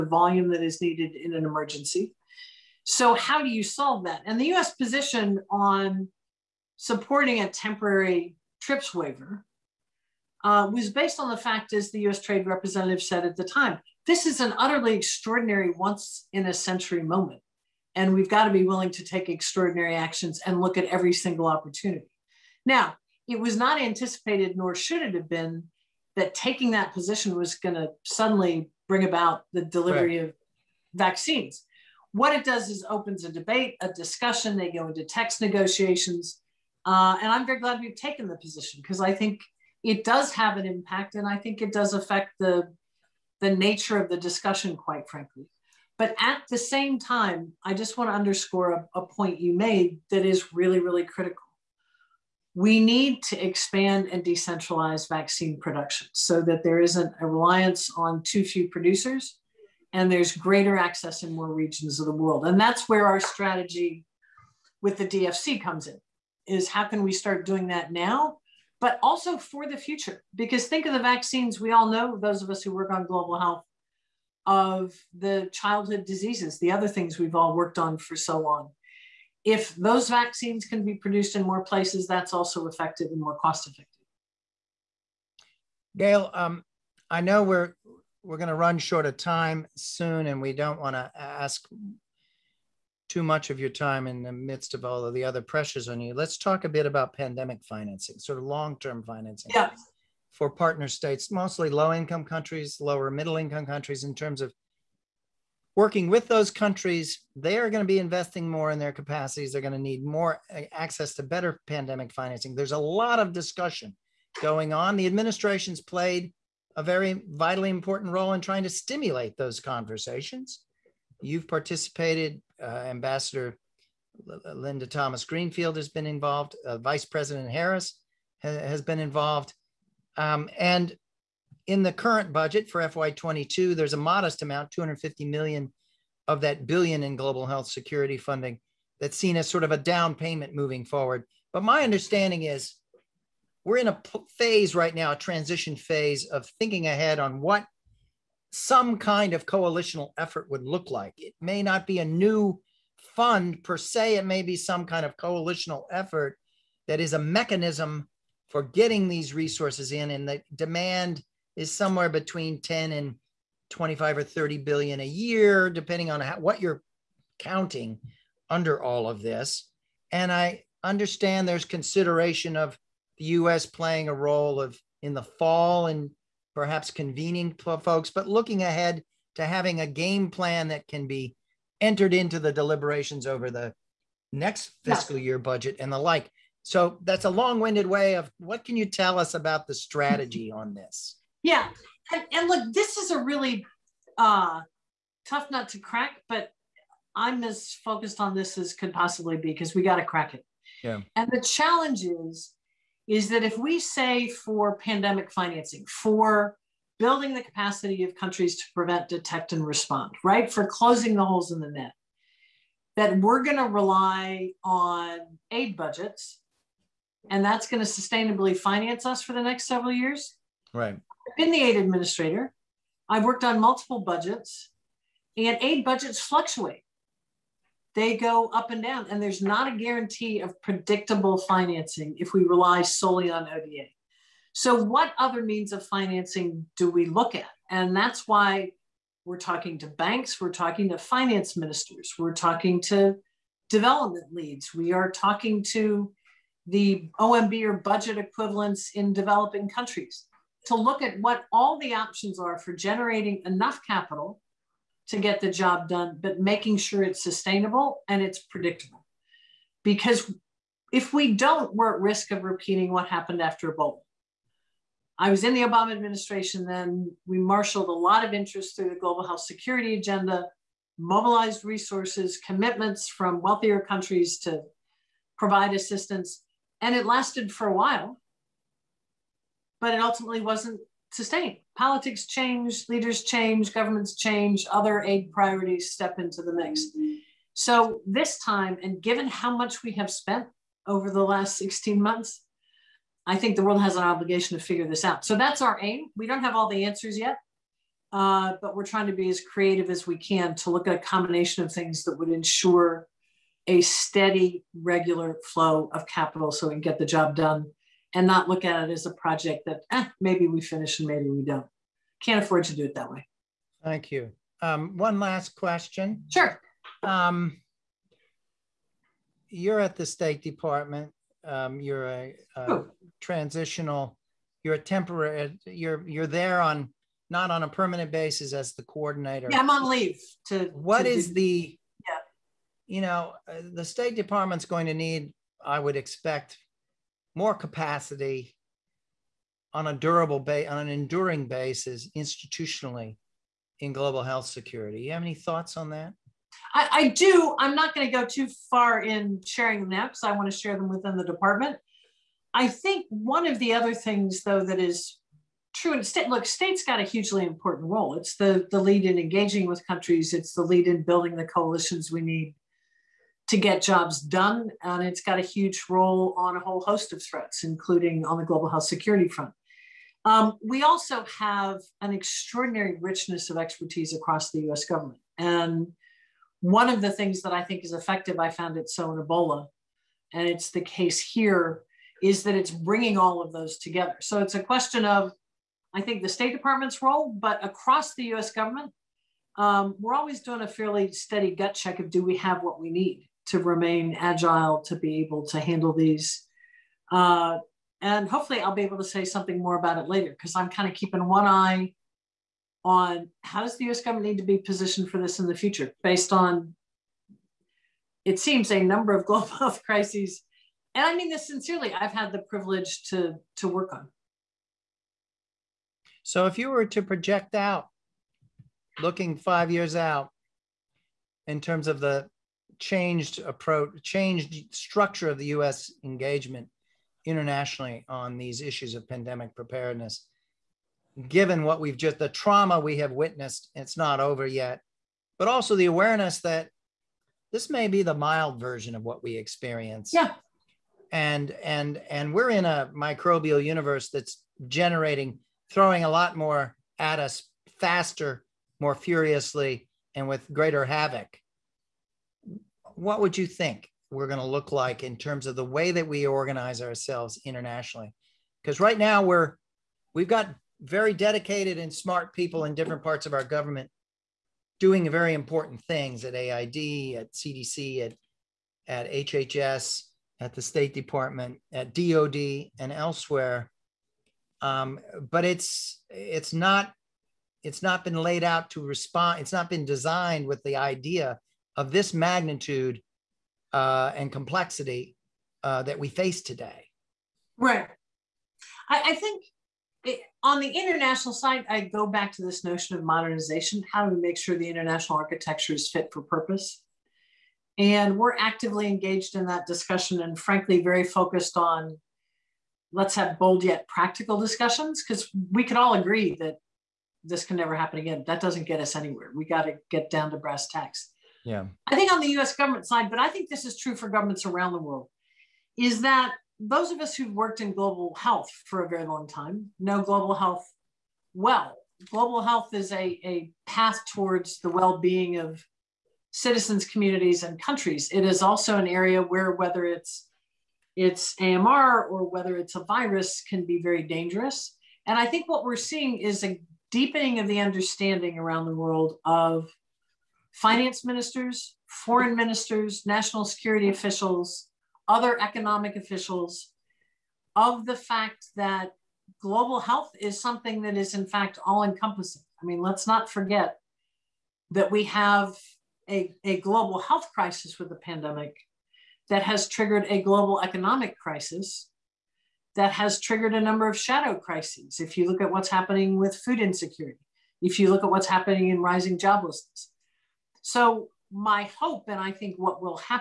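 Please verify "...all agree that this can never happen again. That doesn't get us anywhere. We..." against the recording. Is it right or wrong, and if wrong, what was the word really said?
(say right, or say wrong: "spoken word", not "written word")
right.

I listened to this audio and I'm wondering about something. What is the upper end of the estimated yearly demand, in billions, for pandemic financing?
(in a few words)
30 billion.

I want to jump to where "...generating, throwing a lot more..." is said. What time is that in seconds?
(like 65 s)
444 s.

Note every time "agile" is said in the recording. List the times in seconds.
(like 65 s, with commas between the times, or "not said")
394 s.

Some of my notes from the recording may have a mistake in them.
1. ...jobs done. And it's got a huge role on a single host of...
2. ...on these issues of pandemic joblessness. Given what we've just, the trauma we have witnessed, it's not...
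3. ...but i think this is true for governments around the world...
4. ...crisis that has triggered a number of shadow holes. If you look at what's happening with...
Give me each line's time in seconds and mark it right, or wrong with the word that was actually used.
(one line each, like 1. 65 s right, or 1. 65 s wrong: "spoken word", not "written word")
1. 363 s wrong: "whole", not "single"
2. 428 s wrong: "preparedness", not "joblessness"
3. 513 s right
4. 561 s wrong: "crises", not "holes".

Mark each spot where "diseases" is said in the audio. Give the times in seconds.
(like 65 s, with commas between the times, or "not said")
76 s.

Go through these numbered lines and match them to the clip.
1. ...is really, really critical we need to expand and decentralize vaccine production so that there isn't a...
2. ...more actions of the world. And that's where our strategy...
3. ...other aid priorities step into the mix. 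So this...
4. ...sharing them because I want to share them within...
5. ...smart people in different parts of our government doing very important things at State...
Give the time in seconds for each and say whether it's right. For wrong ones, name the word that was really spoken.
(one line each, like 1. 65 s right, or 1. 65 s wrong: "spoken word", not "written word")
1. 50 s right
2. 61 s wrong: "regions", not "actions"
3. 284 s right
4. 349 s right
5. 461 s wrong: "AID", not "State".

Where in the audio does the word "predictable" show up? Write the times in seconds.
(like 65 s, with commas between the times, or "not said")
230 s, 258 s.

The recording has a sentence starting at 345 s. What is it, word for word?
You have any thoughts on that?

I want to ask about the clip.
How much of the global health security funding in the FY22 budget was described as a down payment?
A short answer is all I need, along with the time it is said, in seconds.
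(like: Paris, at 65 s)
$250 million, at 134 s.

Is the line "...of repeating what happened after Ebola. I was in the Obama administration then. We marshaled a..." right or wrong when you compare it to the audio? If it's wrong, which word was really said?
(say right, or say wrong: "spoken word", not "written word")
right.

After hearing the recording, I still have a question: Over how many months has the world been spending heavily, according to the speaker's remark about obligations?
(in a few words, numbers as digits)
16 months.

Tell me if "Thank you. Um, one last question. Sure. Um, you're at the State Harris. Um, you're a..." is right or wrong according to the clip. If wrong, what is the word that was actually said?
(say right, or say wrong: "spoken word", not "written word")
wrong: "Department", not "Harris".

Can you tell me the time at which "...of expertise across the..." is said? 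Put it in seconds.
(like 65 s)
373 s.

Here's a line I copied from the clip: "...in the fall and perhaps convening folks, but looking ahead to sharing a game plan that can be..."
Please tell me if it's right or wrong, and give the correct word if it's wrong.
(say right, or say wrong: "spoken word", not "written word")
wrong: "having", not "sharing".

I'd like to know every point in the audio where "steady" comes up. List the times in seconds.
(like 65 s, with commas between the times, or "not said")
303 s, 391 s.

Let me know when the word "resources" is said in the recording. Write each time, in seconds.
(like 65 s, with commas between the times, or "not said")
159 s, 271 s.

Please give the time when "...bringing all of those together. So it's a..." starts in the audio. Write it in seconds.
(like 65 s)
382 s.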